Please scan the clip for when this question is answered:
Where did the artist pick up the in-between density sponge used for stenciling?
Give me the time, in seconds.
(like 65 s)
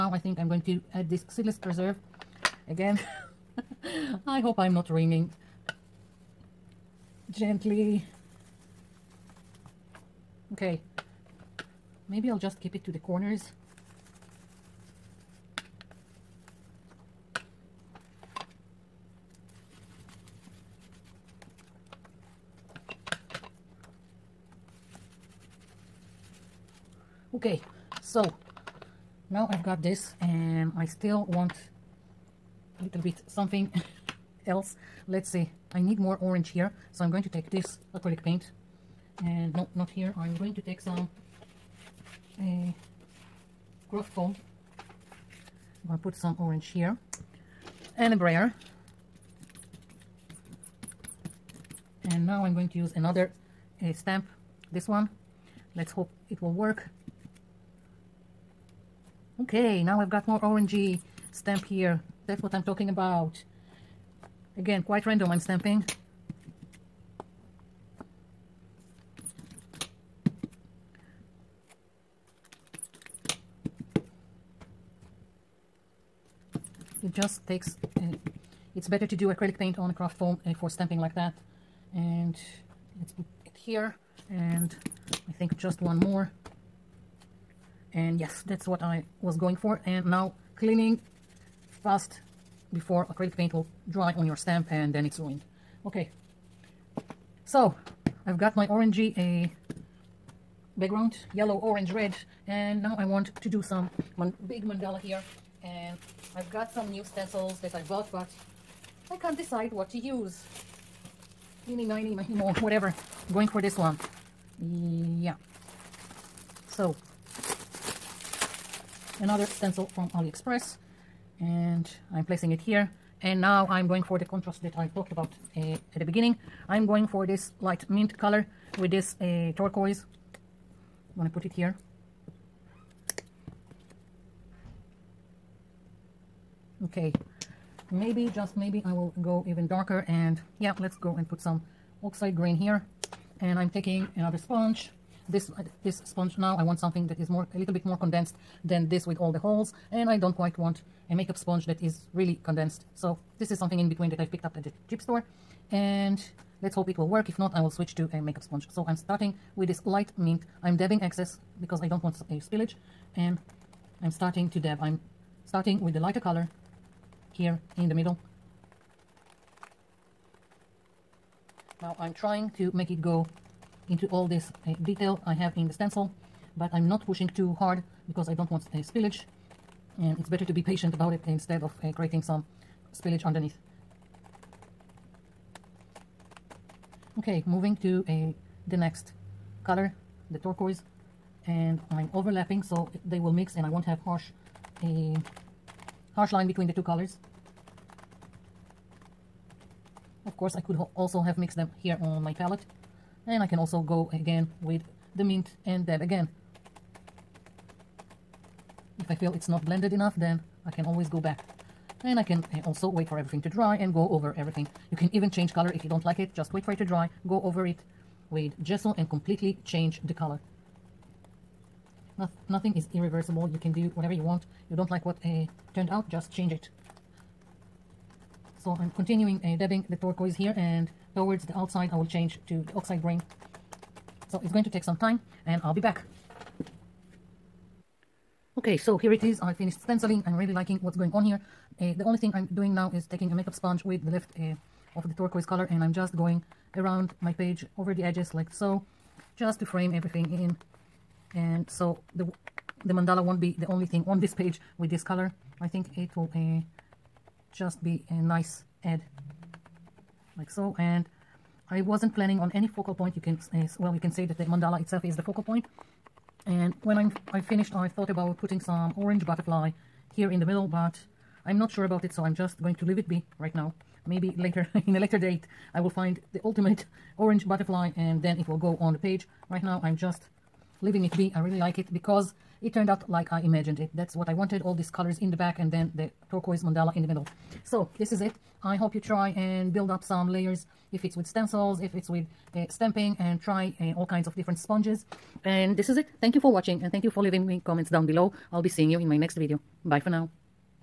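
154 s.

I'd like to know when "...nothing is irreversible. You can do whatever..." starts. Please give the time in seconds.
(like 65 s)
222 s.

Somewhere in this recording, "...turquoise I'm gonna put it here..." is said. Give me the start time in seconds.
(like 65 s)
129 s.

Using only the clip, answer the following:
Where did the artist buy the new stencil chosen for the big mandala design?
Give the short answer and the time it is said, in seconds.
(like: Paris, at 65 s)
AliExpress, at 120 s.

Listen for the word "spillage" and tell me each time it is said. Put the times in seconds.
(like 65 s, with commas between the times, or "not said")
162 s, 178 s, 182 s.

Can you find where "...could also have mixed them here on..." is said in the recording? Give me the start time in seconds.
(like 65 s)
200 s.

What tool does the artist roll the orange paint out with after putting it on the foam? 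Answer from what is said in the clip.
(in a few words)
brayer.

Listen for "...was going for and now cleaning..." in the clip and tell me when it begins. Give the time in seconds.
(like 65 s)
89 s.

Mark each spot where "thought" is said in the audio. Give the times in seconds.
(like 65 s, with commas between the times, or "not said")
267 s.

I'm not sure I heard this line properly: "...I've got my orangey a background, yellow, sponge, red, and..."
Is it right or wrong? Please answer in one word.
wrong.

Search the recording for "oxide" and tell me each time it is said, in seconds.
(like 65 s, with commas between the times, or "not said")
142 s, 232 s.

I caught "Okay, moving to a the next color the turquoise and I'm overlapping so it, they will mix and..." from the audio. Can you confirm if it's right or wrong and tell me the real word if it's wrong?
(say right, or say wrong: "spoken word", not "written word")
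right.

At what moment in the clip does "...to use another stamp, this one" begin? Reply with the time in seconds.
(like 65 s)
52 s.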